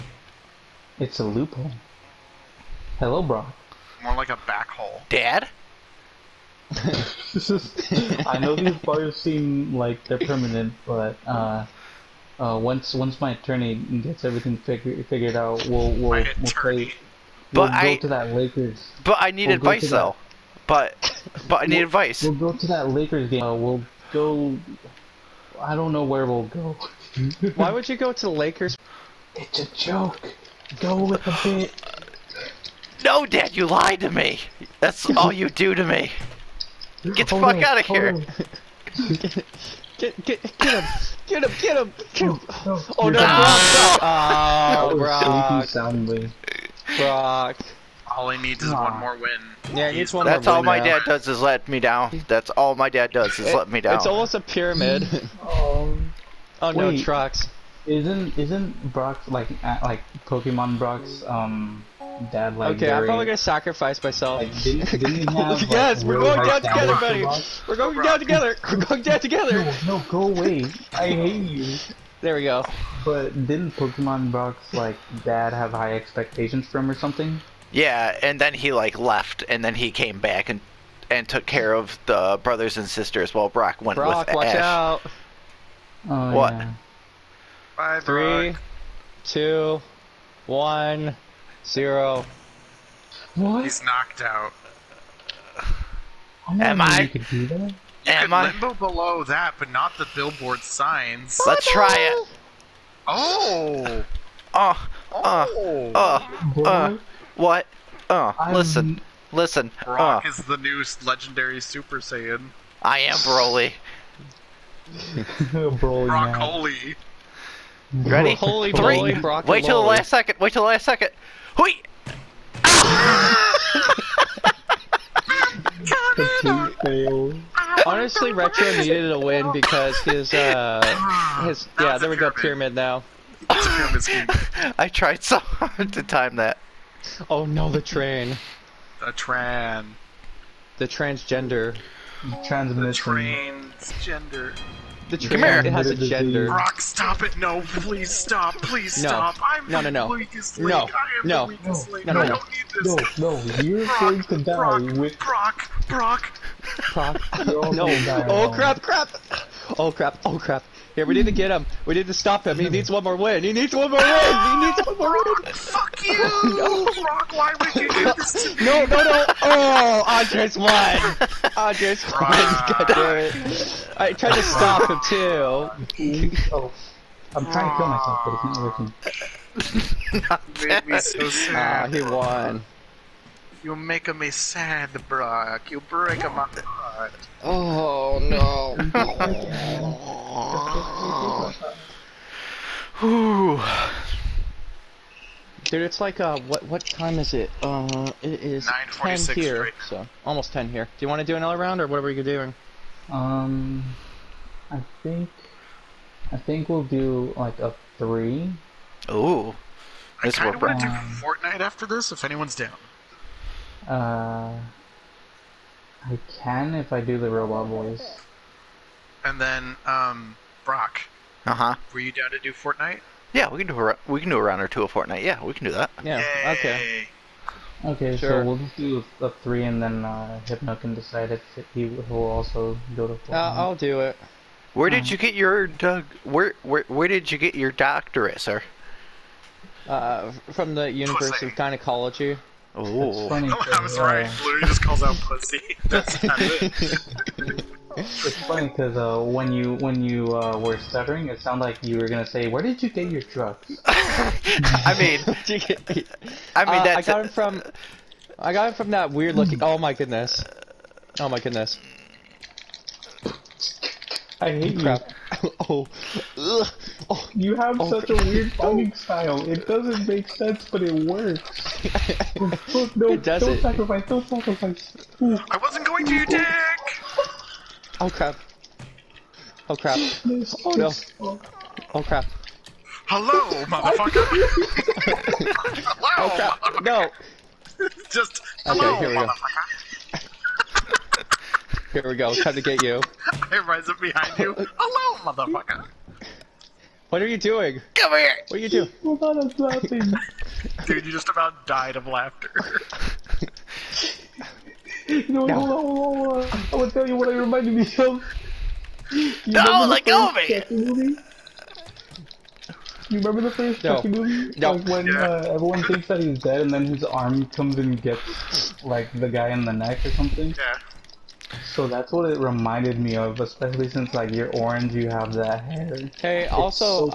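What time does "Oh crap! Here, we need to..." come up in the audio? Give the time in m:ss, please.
2:40.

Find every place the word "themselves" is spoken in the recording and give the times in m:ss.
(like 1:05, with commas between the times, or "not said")
not said.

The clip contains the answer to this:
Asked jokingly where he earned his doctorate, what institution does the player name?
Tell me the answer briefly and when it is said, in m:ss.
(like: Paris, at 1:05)
University of Gynecology, at 4:00.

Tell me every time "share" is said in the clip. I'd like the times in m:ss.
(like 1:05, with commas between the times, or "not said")
not said.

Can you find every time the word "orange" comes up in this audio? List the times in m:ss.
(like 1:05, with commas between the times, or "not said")
5:24.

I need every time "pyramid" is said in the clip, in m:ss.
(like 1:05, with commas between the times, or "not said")
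0:54, 2:12.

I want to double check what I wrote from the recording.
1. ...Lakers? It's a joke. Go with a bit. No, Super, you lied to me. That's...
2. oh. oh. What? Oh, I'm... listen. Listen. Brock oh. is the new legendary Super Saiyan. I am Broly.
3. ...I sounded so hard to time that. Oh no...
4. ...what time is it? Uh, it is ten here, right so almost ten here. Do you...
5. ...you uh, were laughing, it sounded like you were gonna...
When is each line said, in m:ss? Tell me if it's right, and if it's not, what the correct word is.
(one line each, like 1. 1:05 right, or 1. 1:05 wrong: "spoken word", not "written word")
1. 0:28 wrong: "Dad", not "Super"
2. 1:46 right
3. 2:13 wrong: "tried", not "sounded"
4. 3:16 right
5. 4:10 wrong: "stuttering", not "laughing".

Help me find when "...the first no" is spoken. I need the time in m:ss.
5:13.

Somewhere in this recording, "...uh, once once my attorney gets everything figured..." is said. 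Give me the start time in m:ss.
0:12.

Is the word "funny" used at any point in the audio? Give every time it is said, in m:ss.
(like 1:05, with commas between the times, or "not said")
4:03, 4:08.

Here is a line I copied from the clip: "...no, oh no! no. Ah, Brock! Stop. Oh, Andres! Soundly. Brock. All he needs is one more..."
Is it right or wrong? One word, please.
wrong.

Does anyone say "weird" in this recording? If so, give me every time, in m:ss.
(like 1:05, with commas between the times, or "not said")
4:19, 4:28.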